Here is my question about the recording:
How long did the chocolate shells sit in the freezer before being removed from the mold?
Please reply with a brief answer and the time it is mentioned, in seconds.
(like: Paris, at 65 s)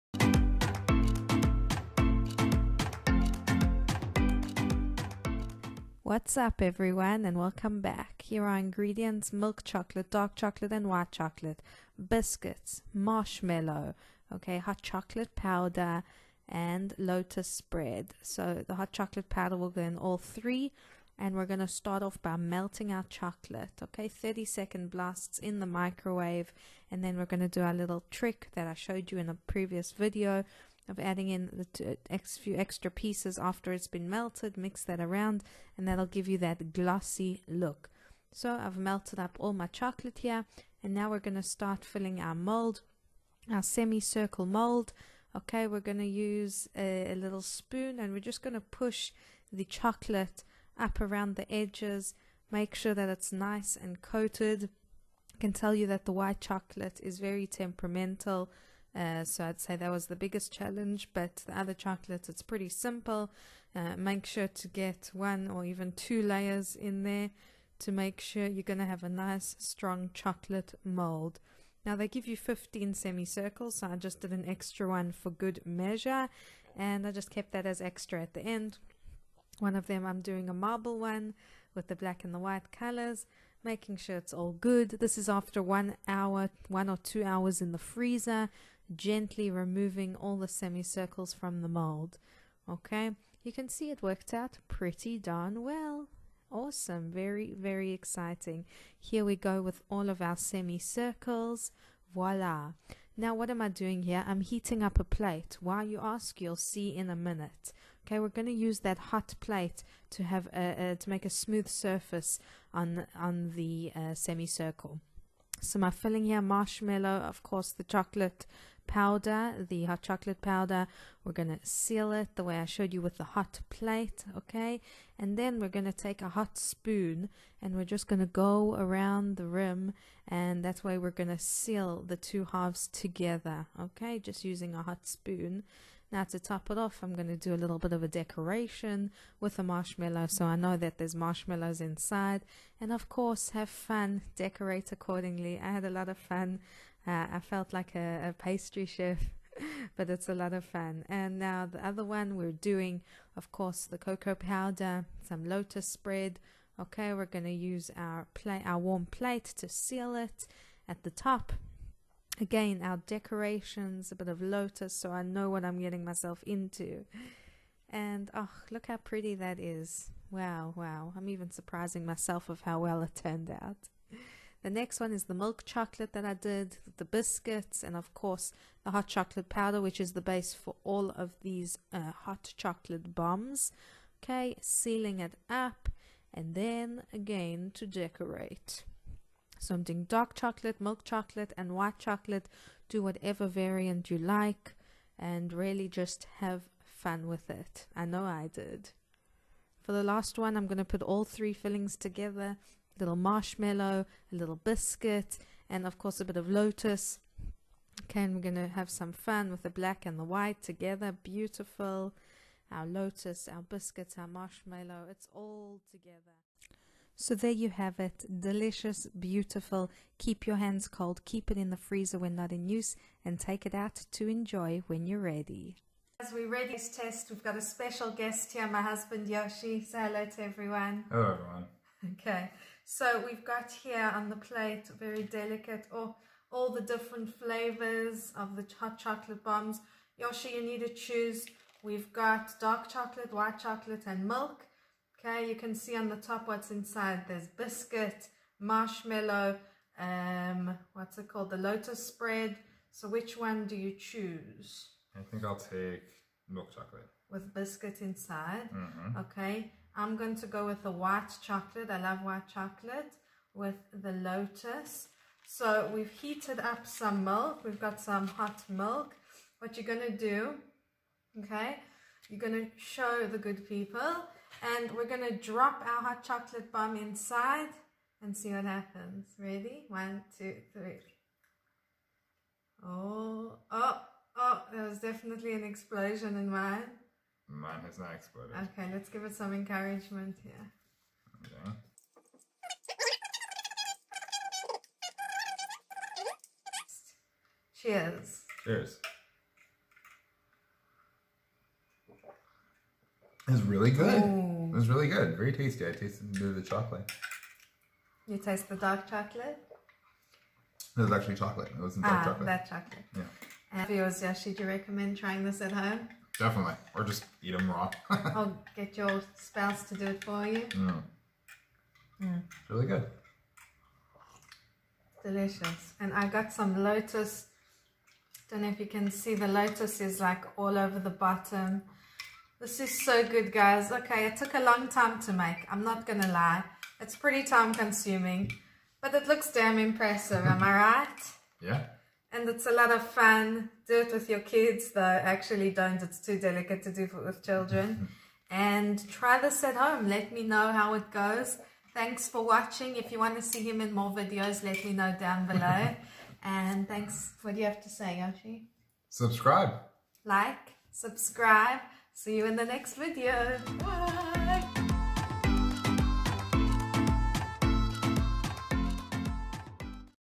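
1 or 2 hours, at 86 s.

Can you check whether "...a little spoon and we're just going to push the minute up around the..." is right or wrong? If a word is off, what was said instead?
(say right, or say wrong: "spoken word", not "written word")
wrong: "chocolate", not "minute".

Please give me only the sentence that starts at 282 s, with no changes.
Oh, oh, oh, there was definitely an explosion in mine.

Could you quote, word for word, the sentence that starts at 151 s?
And now the other one we're doing, of course, the cocoa powder, some lotus spread.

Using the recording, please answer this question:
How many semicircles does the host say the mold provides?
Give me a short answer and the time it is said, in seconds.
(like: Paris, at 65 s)
15, at 72 s.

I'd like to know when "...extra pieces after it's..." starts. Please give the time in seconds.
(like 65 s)
32 s.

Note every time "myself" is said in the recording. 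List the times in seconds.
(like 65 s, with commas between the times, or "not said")
166 s, 172 s.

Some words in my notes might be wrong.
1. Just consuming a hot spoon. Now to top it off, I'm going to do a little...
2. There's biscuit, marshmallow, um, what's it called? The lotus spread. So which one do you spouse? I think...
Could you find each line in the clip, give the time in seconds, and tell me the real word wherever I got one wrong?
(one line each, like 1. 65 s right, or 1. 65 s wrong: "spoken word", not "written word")
1. 134 s wrong: "using", not "consuming"
2. 247 s wrong: "choose", not "spouse".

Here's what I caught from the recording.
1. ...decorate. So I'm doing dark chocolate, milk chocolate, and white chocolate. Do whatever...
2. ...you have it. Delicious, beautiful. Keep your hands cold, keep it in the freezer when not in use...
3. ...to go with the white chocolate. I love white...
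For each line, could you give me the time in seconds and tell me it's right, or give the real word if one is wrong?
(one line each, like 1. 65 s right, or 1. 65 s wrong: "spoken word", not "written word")
1. 187 s right
2. 217 s right
3. 260 s right.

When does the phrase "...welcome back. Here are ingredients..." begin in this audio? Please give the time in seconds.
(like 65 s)
7 s.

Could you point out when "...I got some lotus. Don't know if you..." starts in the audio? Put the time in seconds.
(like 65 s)
326 s.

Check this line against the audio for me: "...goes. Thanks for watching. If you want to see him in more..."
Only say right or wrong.
right.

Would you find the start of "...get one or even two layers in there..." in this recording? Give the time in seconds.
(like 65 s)
64 s.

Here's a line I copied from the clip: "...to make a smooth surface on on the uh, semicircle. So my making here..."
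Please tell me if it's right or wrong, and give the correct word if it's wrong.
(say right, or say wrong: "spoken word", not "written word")
wrong: "filling", not "making".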